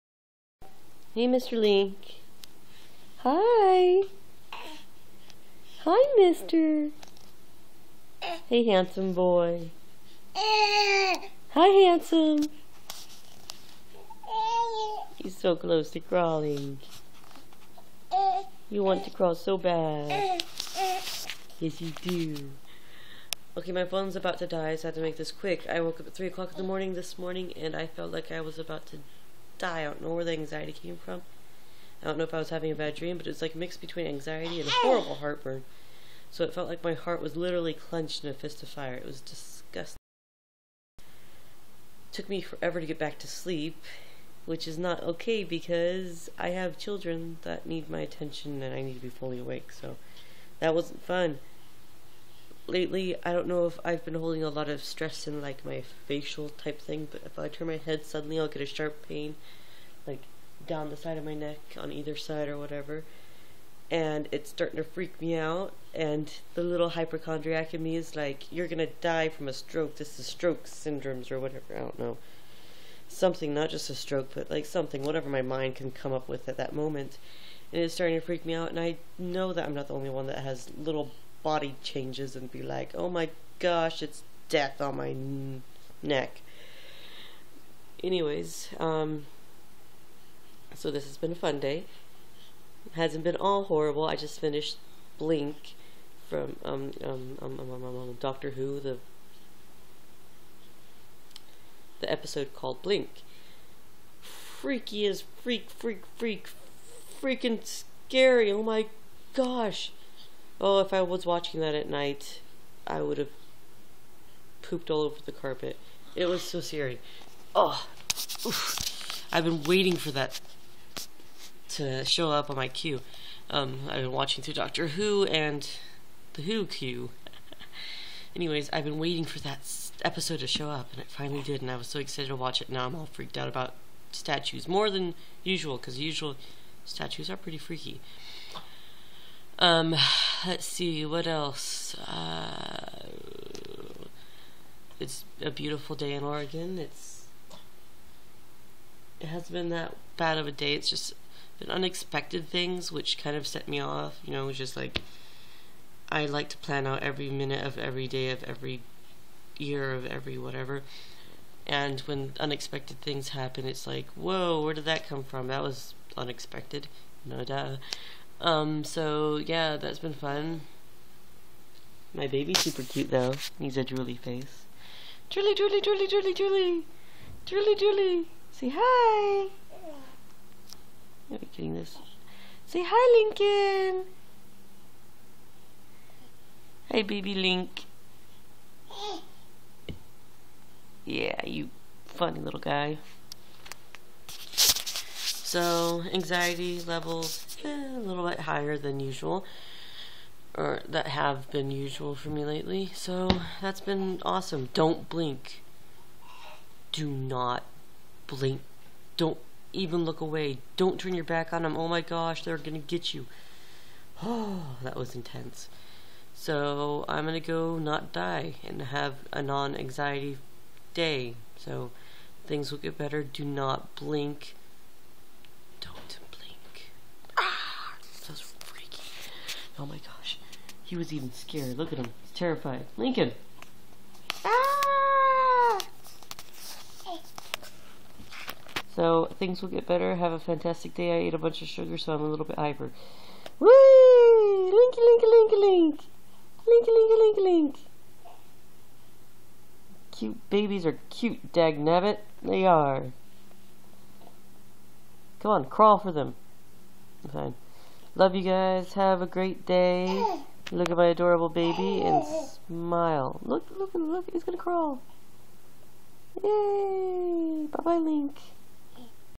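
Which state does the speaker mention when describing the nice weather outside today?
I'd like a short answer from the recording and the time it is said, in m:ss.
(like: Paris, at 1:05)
Oregon, at 2:26.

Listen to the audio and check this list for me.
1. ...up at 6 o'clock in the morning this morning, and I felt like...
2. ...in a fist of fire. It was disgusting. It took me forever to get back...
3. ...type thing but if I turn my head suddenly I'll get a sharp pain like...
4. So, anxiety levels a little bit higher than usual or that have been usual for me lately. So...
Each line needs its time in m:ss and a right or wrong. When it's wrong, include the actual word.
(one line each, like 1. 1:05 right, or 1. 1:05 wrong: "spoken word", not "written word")
1. 0:25 wrong: "3", not "6"
2. 0:38 right
3. 0:56 right
4. 3:14 right.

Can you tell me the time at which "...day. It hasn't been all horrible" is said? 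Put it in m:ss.
1:31.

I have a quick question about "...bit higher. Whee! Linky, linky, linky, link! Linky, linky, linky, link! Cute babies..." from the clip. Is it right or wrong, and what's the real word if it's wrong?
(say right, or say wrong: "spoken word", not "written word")
wrong: "hyper", not "higher".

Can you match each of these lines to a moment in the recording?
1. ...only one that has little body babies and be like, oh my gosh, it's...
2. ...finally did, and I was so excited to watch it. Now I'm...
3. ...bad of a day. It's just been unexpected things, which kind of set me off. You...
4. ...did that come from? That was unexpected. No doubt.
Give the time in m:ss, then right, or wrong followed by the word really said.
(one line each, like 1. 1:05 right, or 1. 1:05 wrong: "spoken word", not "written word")
1. 1:19 wrong: "changes", not "babies"
2. 2:11 right
3. 2:30 right
4. 2:44 right.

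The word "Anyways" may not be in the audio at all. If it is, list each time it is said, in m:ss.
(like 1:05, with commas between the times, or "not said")
1:28, 2:08.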